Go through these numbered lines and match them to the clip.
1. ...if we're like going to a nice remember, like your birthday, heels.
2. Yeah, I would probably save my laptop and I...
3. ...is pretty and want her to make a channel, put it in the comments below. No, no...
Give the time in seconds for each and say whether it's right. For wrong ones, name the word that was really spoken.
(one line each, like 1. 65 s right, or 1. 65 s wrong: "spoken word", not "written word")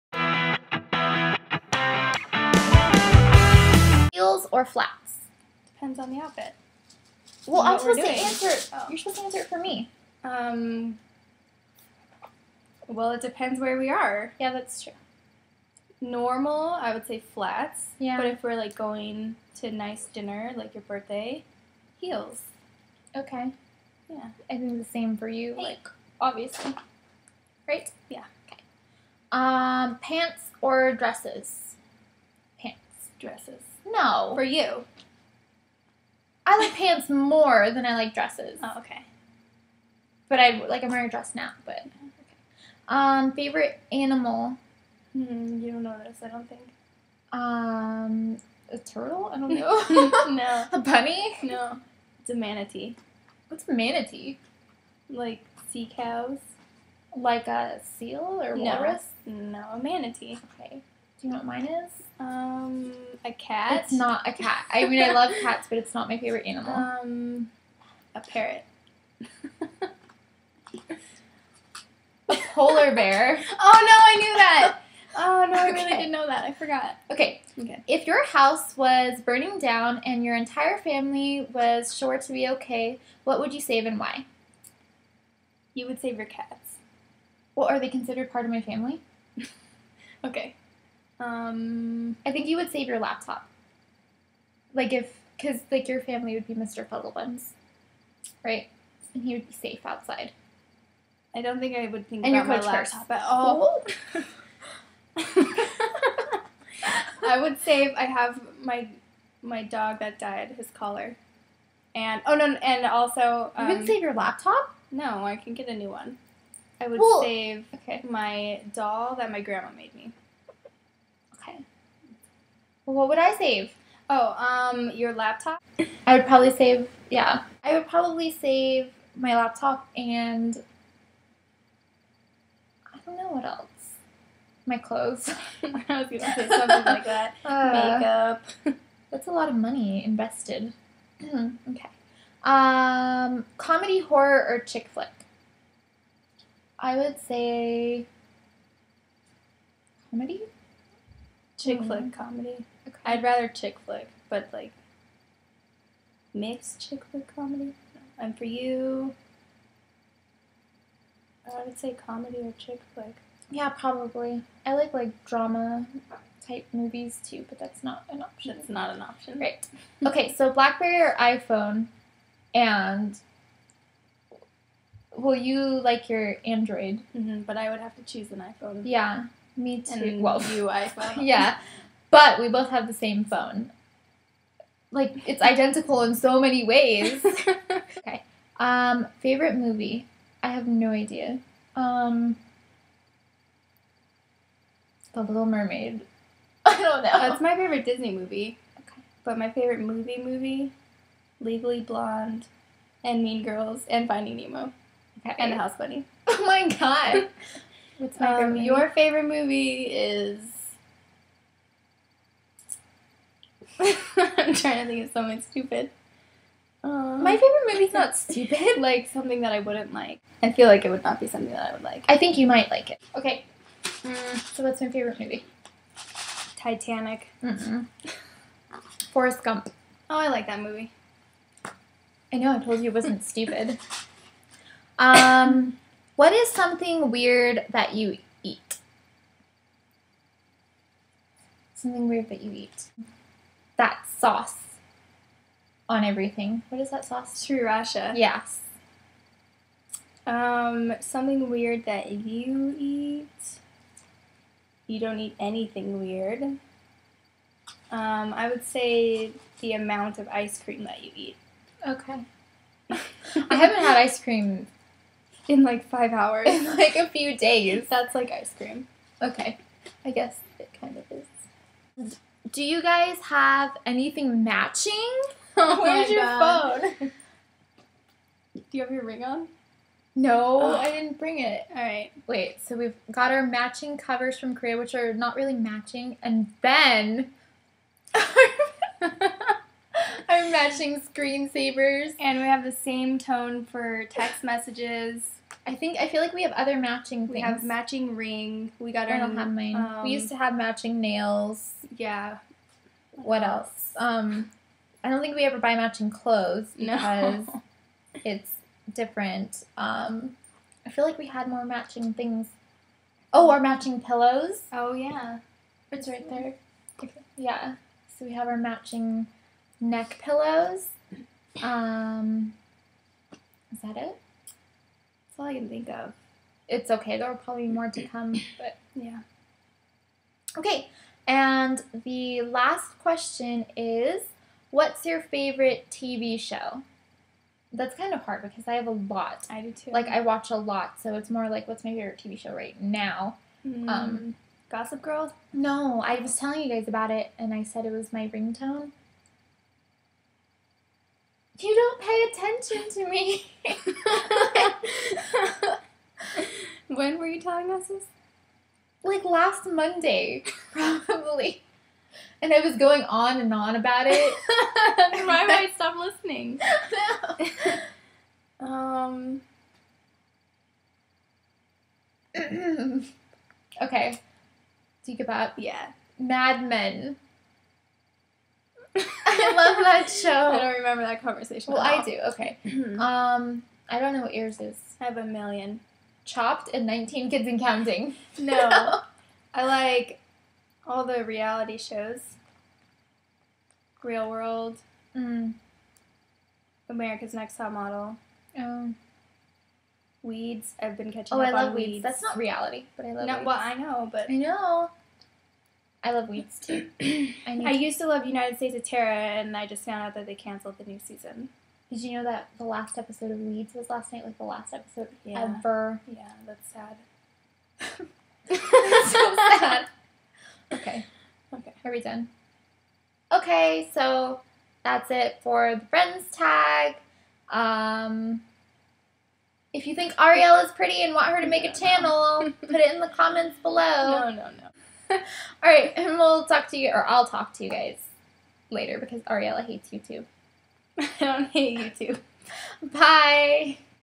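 1. 18 s wrong: "dinner", not "remember"
2. 127 s right
3. 430 s right.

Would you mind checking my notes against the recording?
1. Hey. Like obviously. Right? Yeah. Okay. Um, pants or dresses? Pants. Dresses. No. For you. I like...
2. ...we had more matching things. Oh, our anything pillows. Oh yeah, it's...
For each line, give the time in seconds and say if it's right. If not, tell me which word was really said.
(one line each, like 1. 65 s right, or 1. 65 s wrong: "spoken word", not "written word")
1. 25 s right
2. 311 s wrong: "matching", not "anything".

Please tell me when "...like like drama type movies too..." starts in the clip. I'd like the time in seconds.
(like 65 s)
164 s.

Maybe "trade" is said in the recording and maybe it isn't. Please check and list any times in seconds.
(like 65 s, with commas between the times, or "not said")
not said.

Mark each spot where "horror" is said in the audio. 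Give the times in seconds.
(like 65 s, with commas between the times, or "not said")
143 s.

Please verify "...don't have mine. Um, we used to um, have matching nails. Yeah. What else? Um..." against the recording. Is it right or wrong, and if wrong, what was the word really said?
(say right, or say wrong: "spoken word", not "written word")
right.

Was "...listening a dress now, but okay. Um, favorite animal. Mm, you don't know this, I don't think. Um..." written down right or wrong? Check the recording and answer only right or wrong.
wrong.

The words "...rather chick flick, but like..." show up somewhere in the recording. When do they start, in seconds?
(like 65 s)
153 s.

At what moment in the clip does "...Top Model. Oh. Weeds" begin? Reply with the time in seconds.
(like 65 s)
397 s.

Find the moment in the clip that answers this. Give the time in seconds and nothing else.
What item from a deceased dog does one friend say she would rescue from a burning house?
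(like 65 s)
110 s.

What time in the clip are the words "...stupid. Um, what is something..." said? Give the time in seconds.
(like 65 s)
233 s.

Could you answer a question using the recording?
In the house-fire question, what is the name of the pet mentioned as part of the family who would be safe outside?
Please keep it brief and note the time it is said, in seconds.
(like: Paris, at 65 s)
Mr. Fuddlebuns, at 96 s.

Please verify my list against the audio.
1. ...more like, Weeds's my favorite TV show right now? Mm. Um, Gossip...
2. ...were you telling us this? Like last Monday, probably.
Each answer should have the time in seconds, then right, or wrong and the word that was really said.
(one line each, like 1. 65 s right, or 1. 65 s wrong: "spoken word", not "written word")
1. 341 s wrong: "What", not "Weeds"
2. 357 s right.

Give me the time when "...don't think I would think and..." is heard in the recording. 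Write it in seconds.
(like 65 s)
101 s.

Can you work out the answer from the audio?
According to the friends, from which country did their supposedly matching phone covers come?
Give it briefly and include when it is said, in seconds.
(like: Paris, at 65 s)
Korea, at 284 s.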